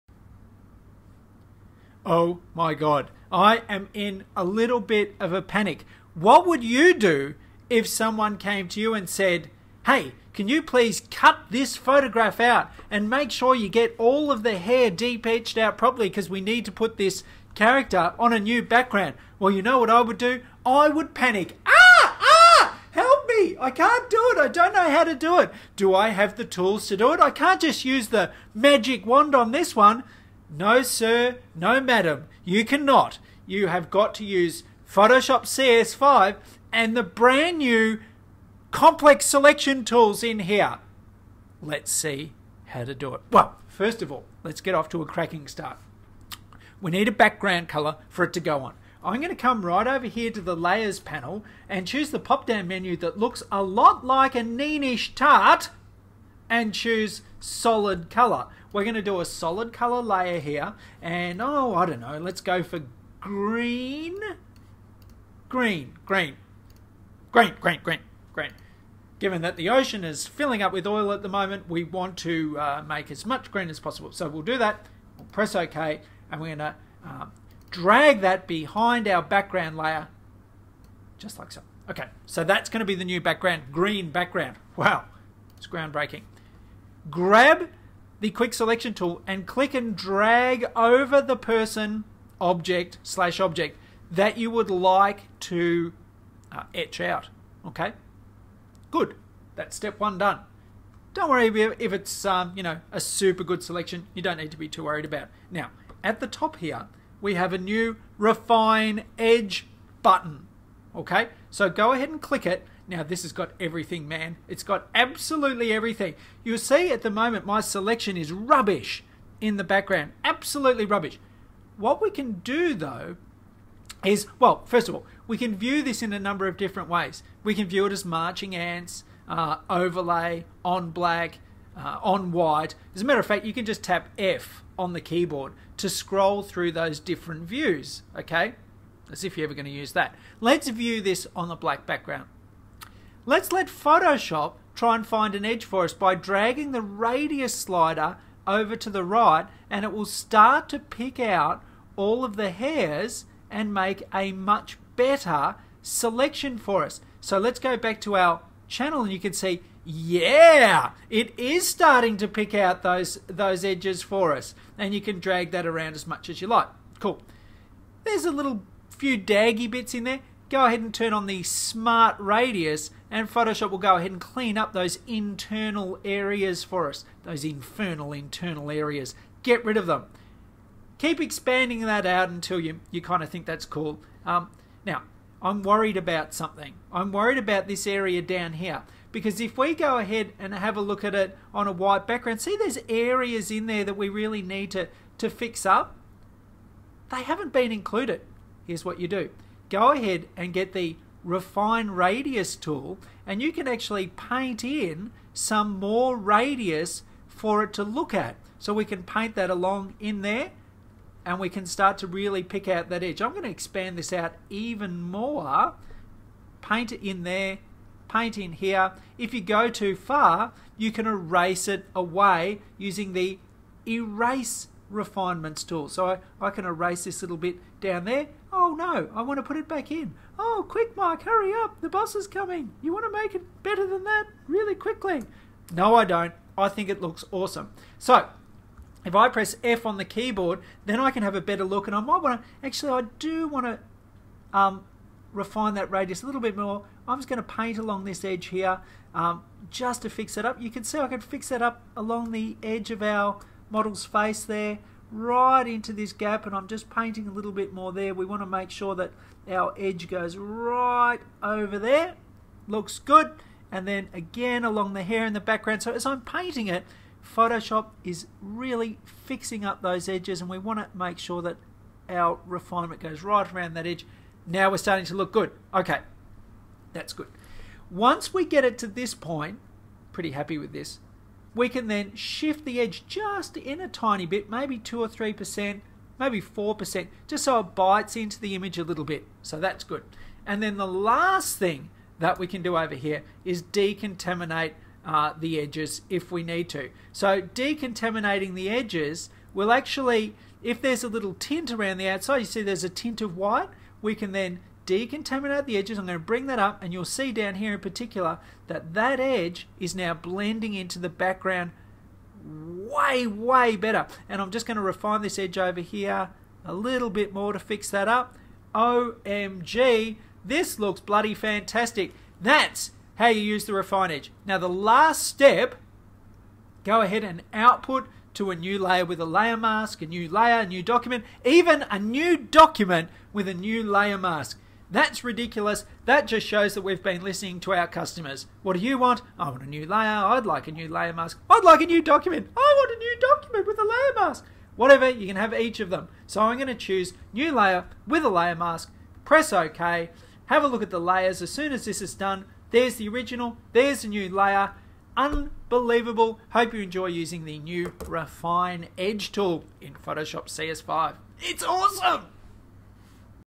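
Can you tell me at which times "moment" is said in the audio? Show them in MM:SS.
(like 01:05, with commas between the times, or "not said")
01:11, 01:57.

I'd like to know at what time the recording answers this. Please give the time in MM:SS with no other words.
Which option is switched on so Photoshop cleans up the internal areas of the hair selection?
02:51.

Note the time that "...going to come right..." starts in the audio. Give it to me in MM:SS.
00:49.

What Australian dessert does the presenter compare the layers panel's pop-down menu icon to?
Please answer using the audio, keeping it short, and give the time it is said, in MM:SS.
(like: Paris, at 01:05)
Neenish tart, at 00:54.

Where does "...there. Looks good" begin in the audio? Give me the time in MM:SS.
04:21.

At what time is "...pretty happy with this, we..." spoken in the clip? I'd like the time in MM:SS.
04:40.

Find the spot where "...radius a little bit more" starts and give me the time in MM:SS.
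04:05.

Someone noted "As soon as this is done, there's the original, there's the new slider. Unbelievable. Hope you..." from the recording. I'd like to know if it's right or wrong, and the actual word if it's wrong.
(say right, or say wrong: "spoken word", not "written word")
wrong: "layer", not "slider".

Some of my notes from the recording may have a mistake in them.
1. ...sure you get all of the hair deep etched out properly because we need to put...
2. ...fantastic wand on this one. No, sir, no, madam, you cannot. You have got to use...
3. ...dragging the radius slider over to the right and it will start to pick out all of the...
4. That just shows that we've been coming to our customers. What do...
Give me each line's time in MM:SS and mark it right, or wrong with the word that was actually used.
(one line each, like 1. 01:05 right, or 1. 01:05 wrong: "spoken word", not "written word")
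1. 00:13 right
2. 00:28 wrong: "magic", not "fantastic"
3. 02:26 right
4. 05:36 wrong: "listening", not "coming".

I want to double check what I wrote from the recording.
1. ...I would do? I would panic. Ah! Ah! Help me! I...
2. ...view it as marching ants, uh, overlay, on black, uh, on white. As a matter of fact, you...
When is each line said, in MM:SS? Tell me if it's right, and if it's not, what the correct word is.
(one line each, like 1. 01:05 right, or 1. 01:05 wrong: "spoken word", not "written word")
1. 00:19 right
2. 02:07 right.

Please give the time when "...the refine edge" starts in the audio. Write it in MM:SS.
05:23.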